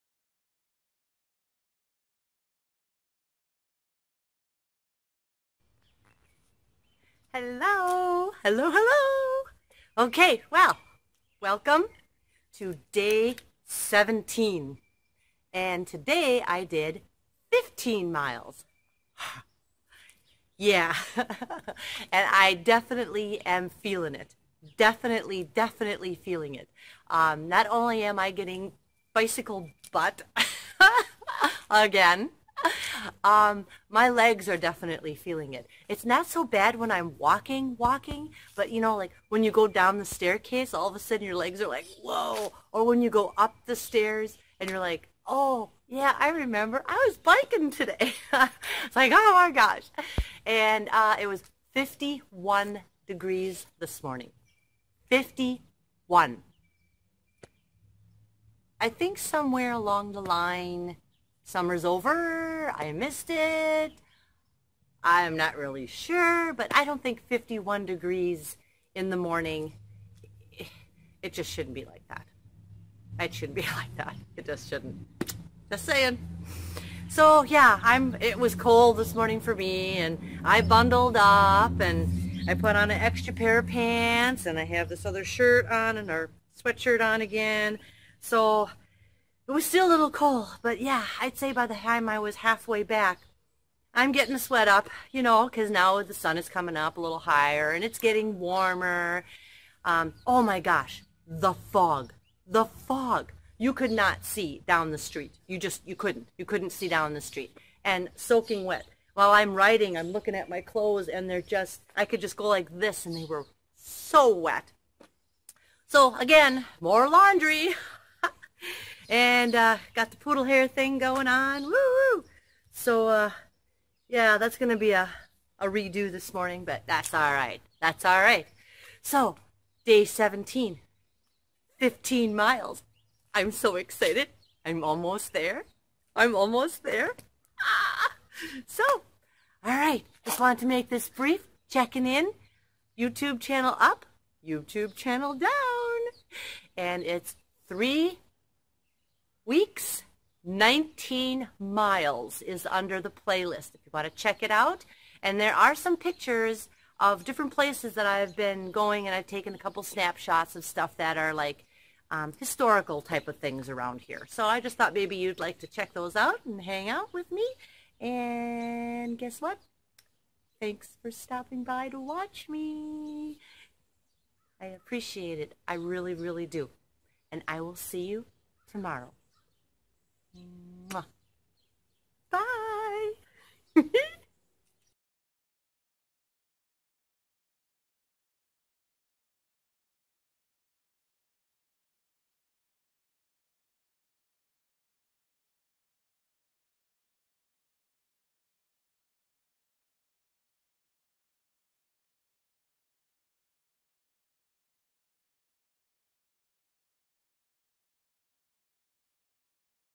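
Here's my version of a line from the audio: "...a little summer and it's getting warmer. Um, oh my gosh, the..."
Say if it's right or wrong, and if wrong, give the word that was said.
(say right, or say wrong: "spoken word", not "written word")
wrong: "higher", not "summer".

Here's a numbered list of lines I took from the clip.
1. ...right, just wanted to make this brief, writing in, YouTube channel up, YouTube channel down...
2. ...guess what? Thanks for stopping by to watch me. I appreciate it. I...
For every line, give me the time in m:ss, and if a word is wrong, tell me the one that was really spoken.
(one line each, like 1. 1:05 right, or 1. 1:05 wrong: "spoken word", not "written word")
1. 2:19 wrong: "checking", not "writing"
2. 2:49 right.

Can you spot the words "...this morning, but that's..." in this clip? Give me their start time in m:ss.
2:06.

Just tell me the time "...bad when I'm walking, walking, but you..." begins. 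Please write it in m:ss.
0:36.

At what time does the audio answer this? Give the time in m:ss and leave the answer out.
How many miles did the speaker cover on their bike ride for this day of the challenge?
0:17.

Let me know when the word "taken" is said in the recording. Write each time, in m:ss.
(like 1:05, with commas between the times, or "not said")
2:39.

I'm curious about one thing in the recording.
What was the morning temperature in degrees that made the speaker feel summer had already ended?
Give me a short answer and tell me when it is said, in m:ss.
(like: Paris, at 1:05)
51, at 0:51.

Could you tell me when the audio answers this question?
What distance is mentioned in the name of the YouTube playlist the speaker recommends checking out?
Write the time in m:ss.
2:30.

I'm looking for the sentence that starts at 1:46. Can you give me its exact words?
You couldn't see down the street.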